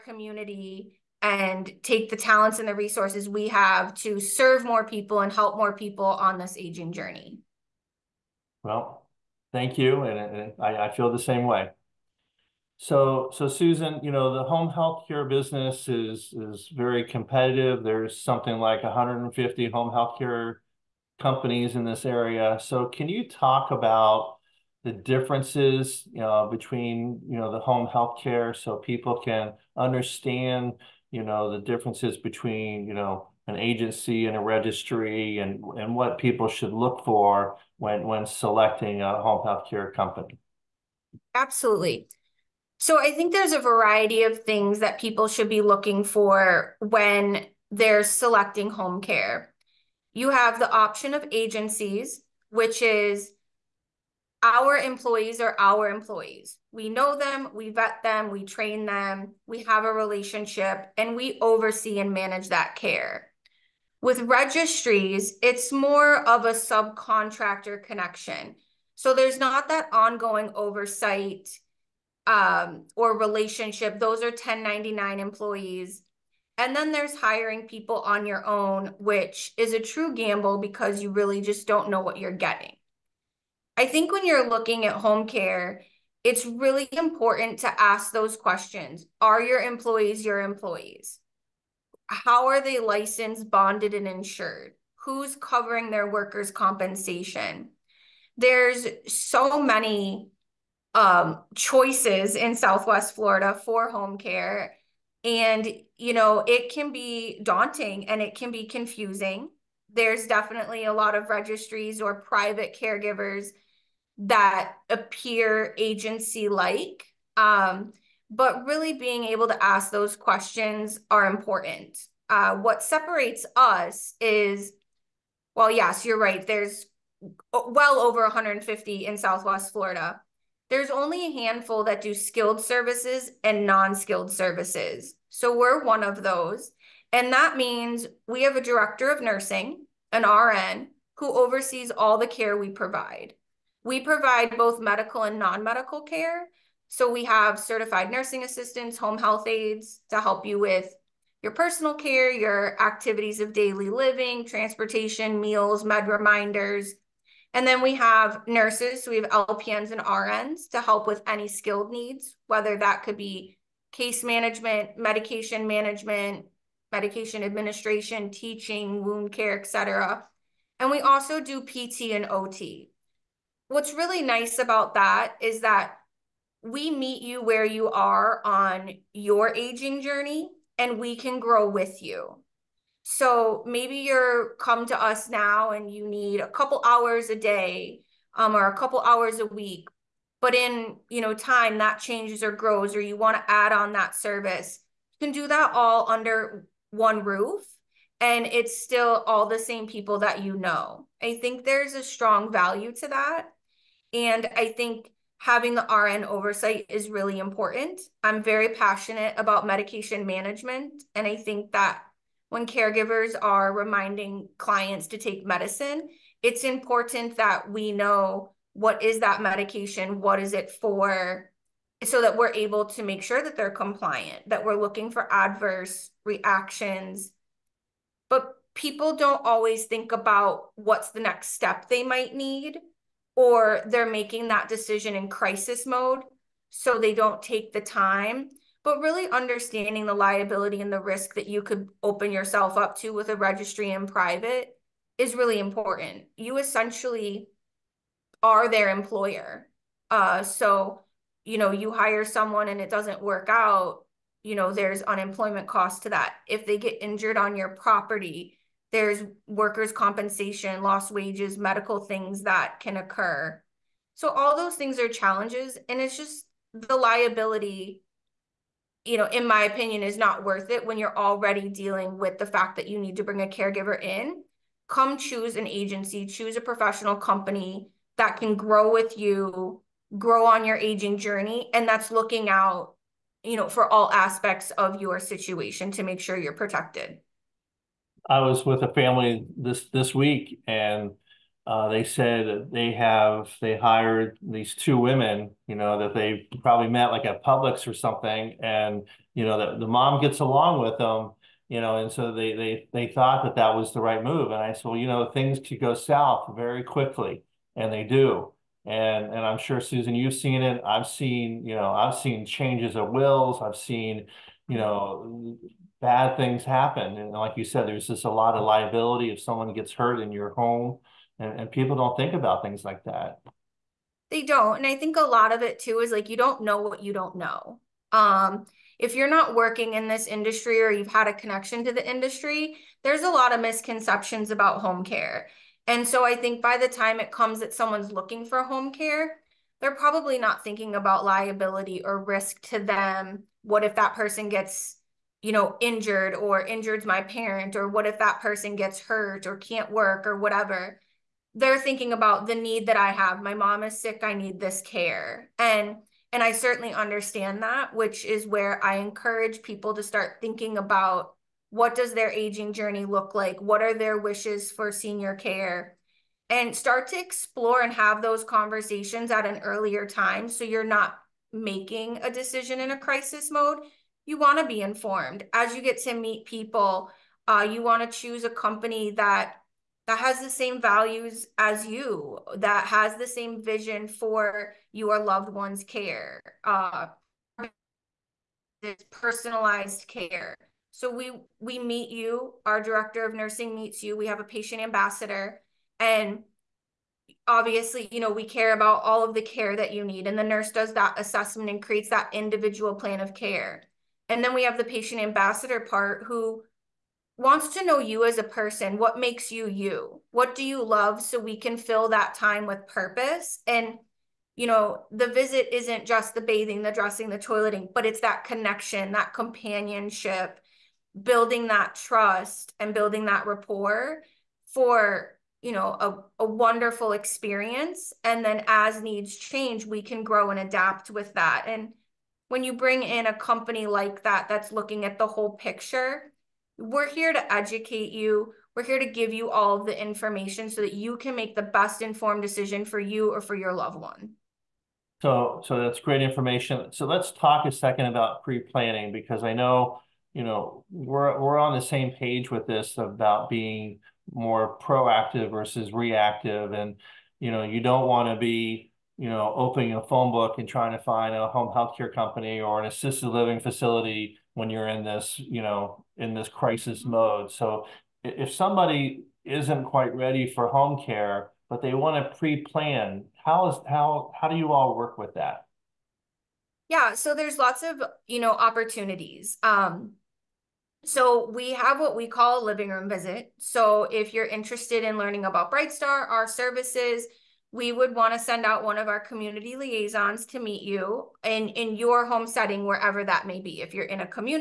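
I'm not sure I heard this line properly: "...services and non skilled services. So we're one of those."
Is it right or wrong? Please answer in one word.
right.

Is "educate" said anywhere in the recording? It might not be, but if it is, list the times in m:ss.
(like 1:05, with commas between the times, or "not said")
7:17.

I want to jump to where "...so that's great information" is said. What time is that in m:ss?
7:25.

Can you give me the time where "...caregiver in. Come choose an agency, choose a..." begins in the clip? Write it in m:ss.
4:33.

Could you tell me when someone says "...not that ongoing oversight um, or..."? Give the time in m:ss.
1:09.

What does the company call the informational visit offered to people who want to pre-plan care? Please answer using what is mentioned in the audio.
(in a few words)
living room visit.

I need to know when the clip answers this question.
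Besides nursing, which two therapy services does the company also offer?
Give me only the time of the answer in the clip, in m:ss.
2:51.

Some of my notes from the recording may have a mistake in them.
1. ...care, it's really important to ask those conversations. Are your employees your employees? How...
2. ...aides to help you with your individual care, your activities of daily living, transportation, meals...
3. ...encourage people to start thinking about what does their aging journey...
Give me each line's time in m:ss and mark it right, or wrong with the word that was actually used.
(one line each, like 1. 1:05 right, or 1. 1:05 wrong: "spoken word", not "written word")
1. 1:25 wrong: "questions", not "conversations"
2. 2:29 wrong: "personal", not "individual"
3. 5:58 right.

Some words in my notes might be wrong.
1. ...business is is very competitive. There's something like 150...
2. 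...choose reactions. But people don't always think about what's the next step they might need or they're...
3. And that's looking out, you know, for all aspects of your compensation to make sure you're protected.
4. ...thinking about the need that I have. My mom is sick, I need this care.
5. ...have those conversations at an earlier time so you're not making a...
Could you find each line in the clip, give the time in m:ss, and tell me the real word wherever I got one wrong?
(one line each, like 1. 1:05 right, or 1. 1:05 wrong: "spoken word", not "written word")
1. 0:15 right
2. 3:45 wrong: "adverse", not "choose"
3. 4:41 wrong: "situation", not "compensation"
4. 5:51 right
5. 6:07 right.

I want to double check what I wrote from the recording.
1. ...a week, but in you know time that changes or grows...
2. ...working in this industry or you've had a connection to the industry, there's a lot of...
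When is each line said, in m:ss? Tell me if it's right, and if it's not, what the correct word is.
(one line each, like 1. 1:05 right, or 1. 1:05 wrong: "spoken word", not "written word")
1. 3:09 right
2. 5:29 right.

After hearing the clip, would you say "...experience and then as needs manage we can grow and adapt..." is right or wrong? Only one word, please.
wrong.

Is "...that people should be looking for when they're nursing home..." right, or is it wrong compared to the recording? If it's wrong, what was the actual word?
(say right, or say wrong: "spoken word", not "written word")
wrong: "selecting", not "nursing".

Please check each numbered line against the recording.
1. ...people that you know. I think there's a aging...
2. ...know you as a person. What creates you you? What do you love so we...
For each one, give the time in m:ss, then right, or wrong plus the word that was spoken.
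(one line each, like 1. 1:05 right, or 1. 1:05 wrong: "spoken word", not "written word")
1. 3:19 wrong: "strong", not "aging"
2. 6:47 wrong: "makes", not "creates".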